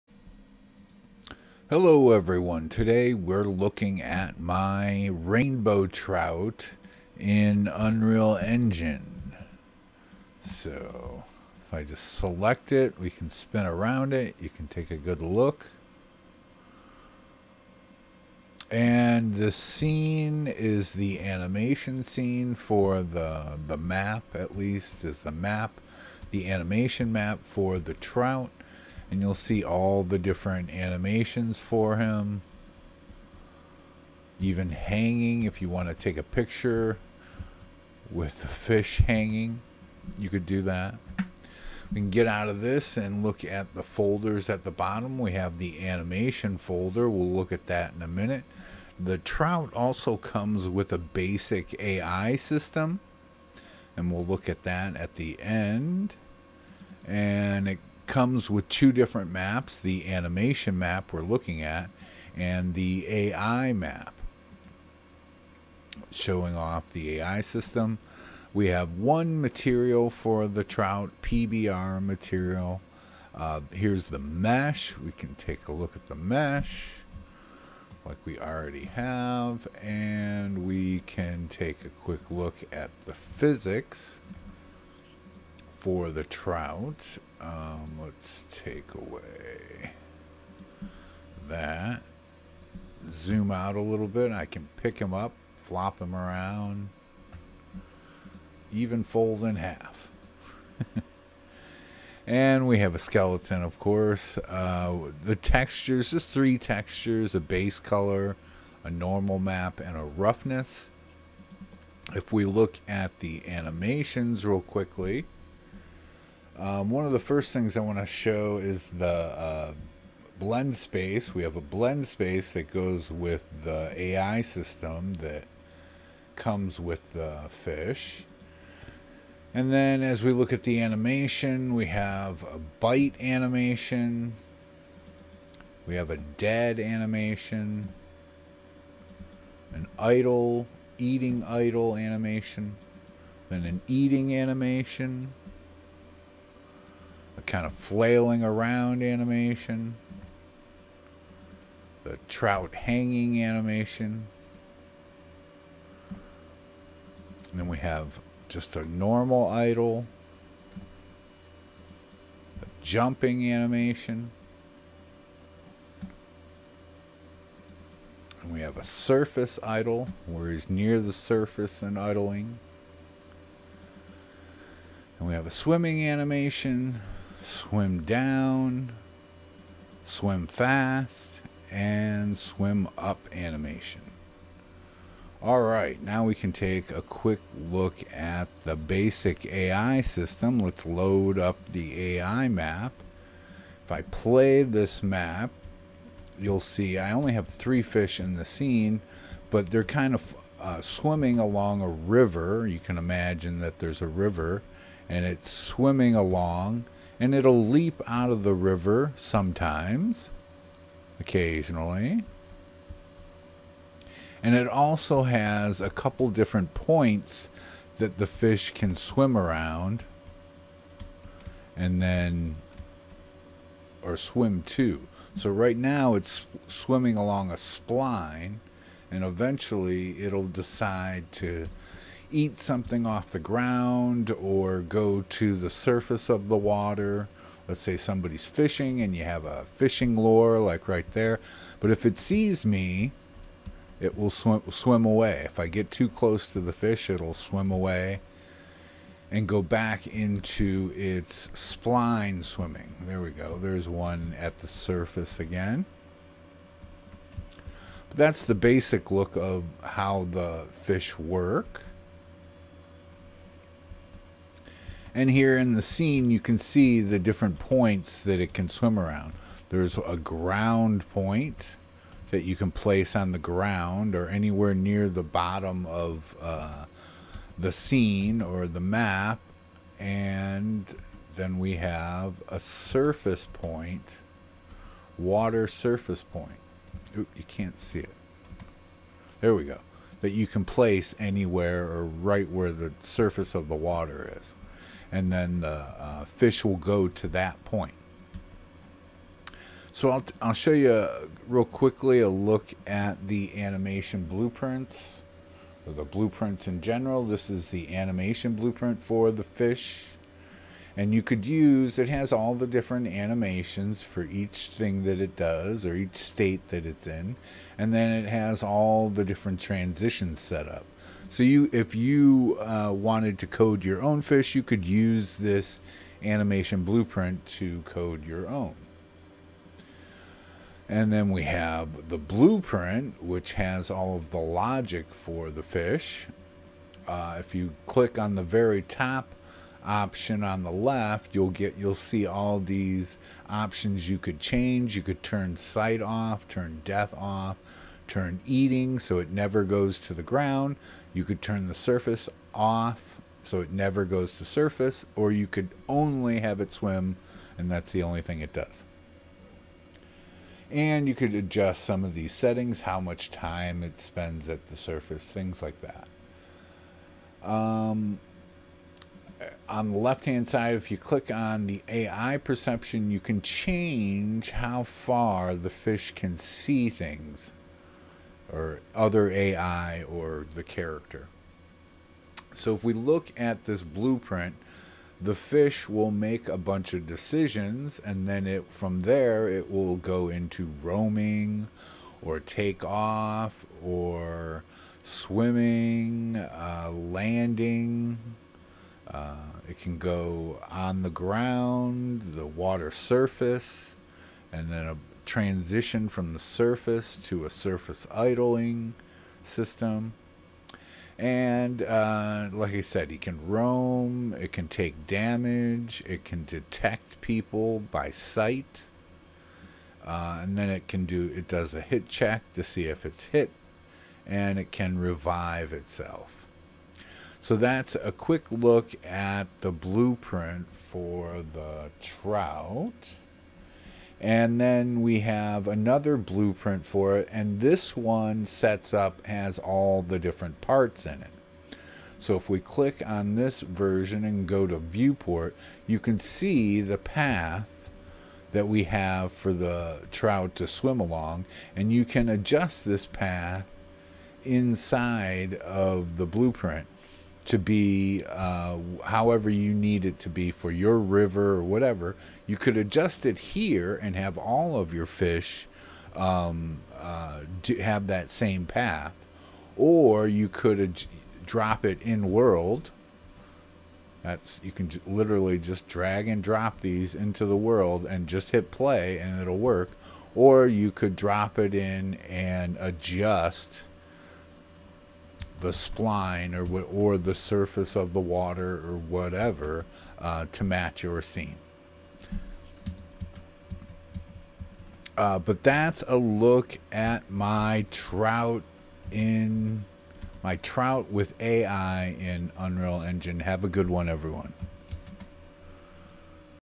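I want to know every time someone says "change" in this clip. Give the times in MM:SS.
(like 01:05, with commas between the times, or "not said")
05:44, 06:13.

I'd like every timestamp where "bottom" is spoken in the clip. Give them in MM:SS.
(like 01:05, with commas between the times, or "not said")
00:44, 04:35.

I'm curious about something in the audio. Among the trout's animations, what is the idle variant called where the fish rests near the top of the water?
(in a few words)
surface idle.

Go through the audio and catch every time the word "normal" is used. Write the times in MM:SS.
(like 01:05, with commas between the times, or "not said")
01:48, 02:38.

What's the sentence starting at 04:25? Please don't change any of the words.
And here in the scene, you can see the different points that it can swim around.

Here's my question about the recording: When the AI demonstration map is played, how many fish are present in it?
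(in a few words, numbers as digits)
3.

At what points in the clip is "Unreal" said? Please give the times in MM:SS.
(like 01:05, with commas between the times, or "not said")
00:07, 08:22.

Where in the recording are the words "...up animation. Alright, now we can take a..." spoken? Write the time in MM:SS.
03:02.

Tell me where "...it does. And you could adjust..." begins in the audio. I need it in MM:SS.
05:58.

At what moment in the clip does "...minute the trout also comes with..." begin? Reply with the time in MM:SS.
00:48.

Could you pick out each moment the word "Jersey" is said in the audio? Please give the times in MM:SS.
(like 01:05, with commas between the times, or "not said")
not said.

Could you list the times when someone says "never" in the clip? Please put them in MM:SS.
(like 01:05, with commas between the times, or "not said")
05:49, 05:53.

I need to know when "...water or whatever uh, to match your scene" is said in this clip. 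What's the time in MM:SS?
08:08.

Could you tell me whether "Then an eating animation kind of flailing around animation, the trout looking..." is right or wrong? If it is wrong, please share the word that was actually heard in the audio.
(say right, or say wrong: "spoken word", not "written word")
wrong: "hanging", not "looking".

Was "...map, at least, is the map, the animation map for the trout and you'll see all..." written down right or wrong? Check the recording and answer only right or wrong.
right.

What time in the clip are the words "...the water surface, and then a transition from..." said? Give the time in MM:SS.
06:42.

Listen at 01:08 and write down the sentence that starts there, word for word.
We have one material for the trout PBR material.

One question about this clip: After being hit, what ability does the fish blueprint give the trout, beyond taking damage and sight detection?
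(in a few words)
revive itself.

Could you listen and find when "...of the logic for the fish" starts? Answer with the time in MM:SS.
05:34.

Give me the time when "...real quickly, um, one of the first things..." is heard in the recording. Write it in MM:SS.
01:54.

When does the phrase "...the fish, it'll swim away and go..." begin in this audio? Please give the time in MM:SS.
04:06.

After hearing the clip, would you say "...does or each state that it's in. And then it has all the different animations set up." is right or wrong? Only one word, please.
wrong.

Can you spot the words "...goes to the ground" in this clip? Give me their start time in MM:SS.
05:49.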